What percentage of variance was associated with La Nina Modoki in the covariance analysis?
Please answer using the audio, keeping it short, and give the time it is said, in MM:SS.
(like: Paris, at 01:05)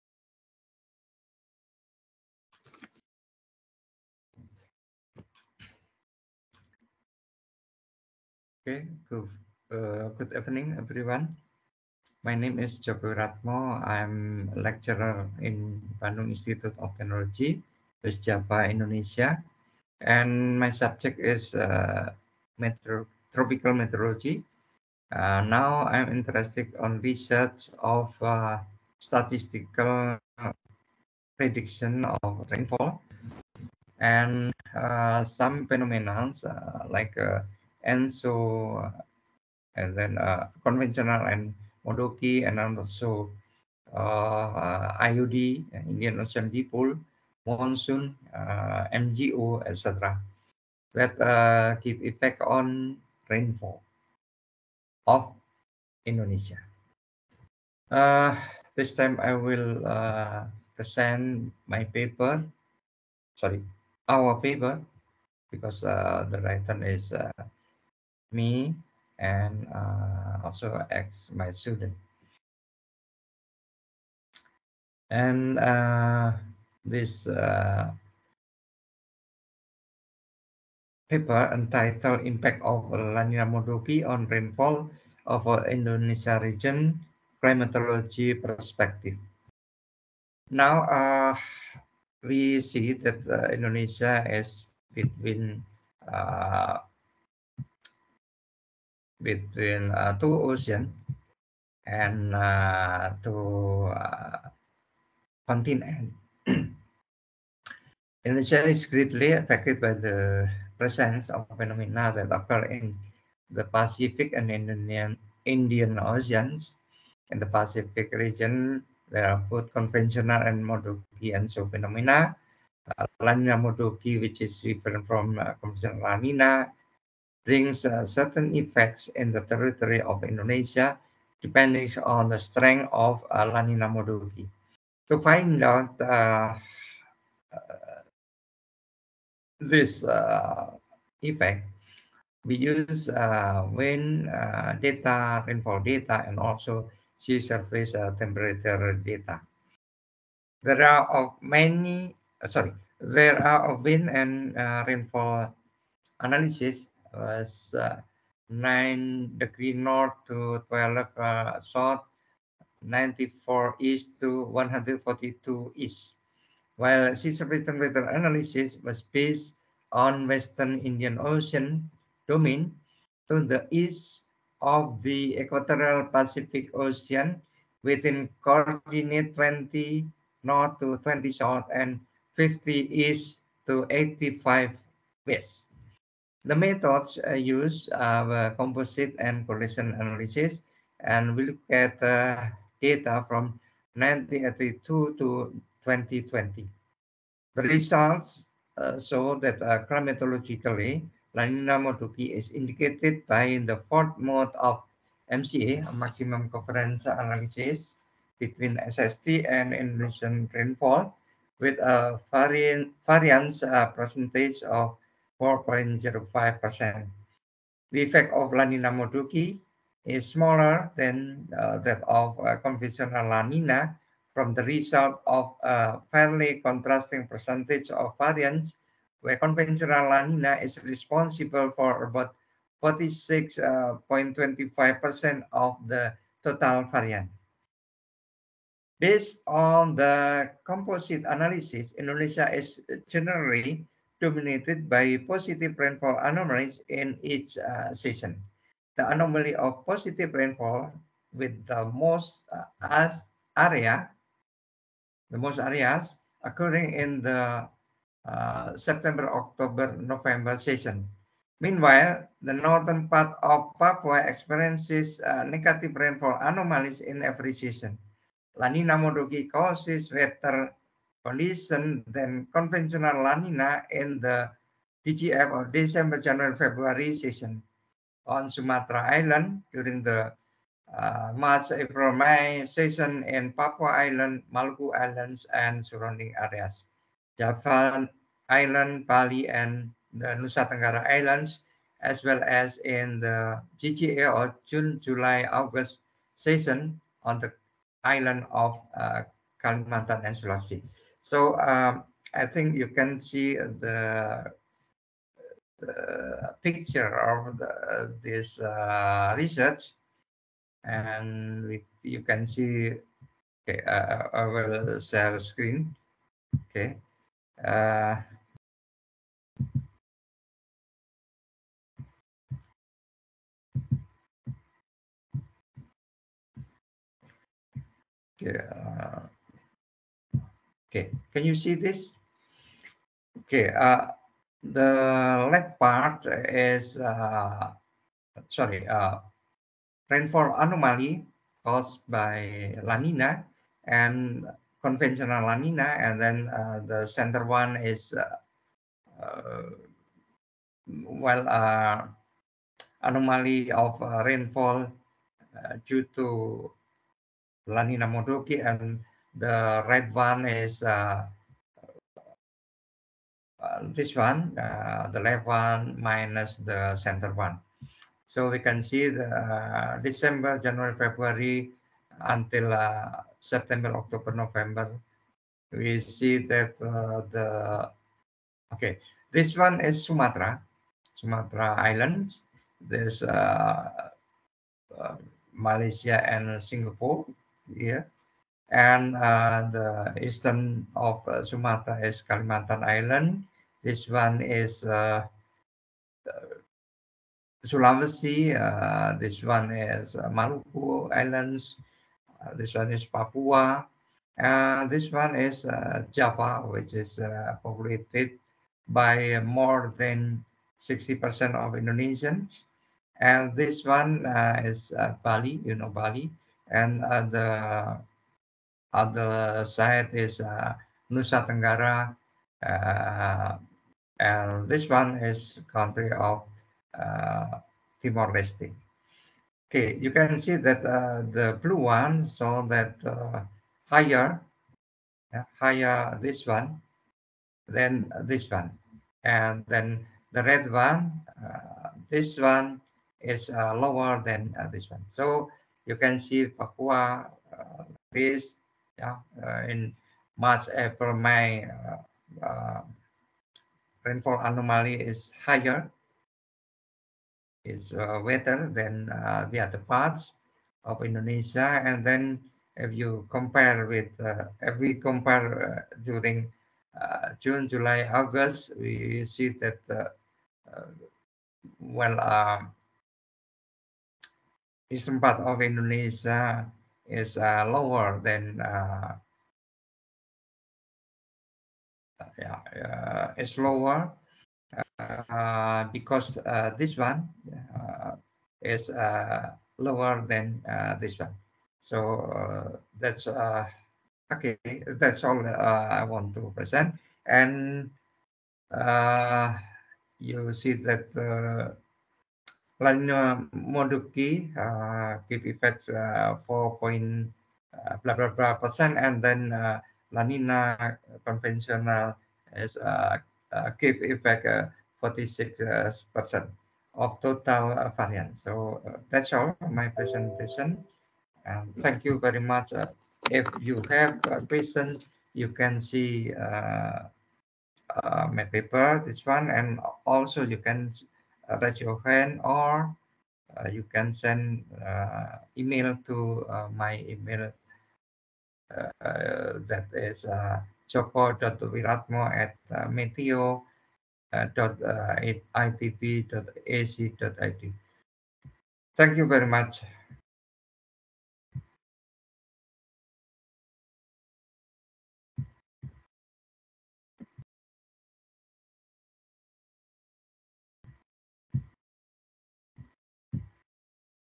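4.05%, at 03:35.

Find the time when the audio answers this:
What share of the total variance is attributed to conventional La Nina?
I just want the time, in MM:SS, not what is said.
03:52.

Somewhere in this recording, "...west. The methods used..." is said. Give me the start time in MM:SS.
03:05.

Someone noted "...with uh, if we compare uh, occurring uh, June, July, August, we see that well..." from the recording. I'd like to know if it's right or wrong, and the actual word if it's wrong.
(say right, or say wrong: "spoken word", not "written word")
wrong: "during", not "occurring".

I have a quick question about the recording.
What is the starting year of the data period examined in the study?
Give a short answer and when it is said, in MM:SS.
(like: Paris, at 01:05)
1982, at 03:13.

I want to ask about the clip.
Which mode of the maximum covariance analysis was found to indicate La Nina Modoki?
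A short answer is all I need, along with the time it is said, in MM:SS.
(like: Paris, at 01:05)
fourth mode, at 03:23.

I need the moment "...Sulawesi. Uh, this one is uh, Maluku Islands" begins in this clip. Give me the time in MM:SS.
06:37.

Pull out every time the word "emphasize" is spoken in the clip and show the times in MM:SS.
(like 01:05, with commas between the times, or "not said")
not said.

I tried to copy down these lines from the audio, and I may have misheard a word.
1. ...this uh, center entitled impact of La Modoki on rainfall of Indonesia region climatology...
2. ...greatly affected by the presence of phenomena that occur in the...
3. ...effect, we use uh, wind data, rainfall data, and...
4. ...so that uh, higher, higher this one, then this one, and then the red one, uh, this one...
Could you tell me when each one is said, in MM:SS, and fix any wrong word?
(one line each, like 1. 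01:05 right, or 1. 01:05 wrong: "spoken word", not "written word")
1. 01:16 wrong: "paper", not "center"
2. 01:48 right
3. 02:21 right
4. 07:12 right.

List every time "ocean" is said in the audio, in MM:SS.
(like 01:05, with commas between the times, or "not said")
00:46, 01:40, 01:56, 02:51, 02:56.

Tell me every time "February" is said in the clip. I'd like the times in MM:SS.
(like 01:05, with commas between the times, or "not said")
04:36, 06:10.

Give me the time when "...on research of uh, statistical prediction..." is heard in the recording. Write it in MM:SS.
00:26.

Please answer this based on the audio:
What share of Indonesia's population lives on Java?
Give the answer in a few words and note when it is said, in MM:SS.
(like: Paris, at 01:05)
more than 60%, at 06:49.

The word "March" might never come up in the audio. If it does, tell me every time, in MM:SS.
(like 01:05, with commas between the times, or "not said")
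04:41, 07:30.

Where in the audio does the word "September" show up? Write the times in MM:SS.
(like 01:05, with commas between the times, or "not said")
04:18, 06:13.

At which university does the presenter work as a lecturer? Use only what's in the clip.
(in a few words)
Bandung Institute of Technology.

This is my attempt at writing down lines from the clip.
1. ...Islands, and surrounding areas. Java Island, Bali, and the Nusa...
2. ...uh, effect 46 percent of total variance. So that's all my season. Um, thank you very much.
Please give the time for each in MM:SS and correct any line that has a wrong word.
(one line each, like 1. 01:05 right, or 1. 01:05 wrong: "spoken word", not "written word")
1. 04:44 right
2. 08:34 wrong: "presentation", not "season".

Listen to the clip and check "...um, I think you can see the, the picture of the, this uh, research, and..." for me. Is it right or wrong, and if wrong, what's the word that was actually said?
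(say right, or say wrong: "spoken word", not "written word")
right.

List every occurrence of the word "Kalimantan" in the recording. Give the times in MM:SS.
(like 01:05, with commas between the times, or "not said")
04:59, 06:32.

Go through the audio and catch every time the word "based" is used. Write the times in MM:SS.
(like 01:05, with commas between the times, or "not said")
02:49, 03:59.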